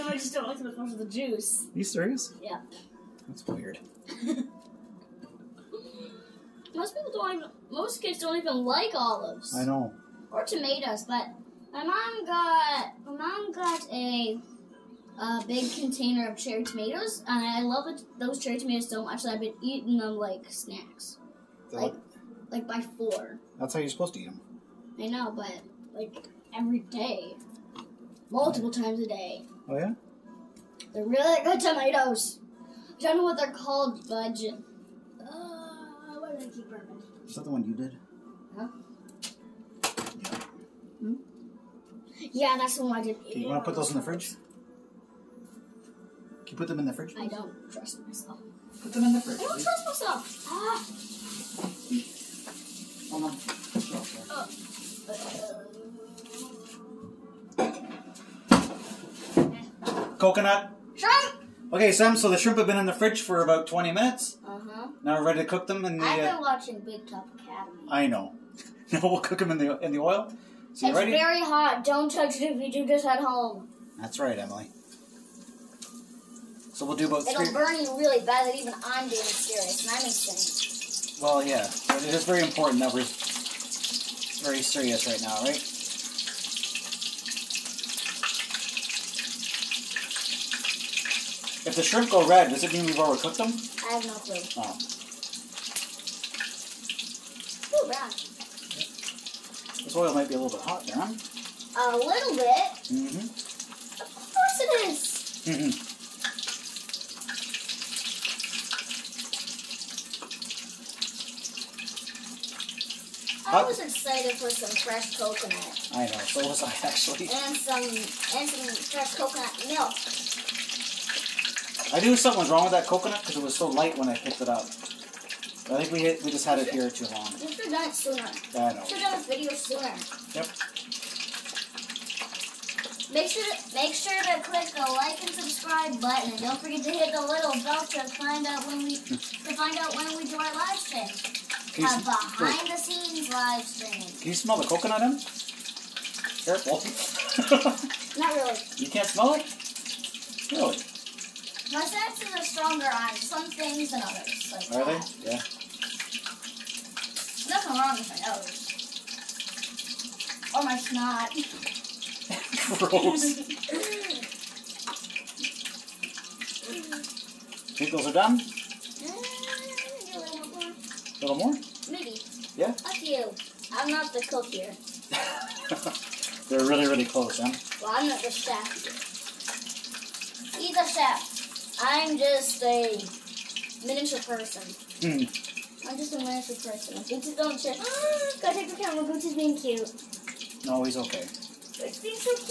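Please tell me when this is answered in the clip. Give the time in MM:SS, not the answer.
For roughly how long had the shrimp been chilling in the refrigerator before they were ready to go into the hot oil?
01:03.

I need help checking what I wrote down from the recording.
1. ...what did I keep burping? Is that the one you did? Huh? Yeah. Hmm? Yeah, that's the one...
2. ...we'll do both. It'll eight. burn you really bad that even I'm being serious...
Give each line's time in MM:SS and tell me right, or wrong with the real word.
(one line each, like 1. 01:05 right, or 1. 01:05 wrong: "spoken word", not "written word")
1. 00:36 right
2. 01:16 wrong: "three", not "eight".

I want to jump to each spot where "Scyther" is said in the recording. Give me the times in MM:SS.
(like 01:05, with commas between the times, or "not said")
not said.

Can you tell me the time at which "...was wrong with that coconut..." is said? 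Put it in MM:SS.
02:02.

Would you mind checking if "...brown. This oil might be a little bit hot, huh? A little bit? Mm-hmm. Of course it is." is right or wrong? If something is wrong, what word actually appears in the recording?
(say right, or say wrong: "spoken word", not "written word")
right.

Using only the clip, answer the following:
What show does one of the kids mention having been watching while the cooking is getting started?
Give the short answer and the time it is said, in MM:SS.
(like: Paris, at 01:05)
Big Top Academy, at 01:06.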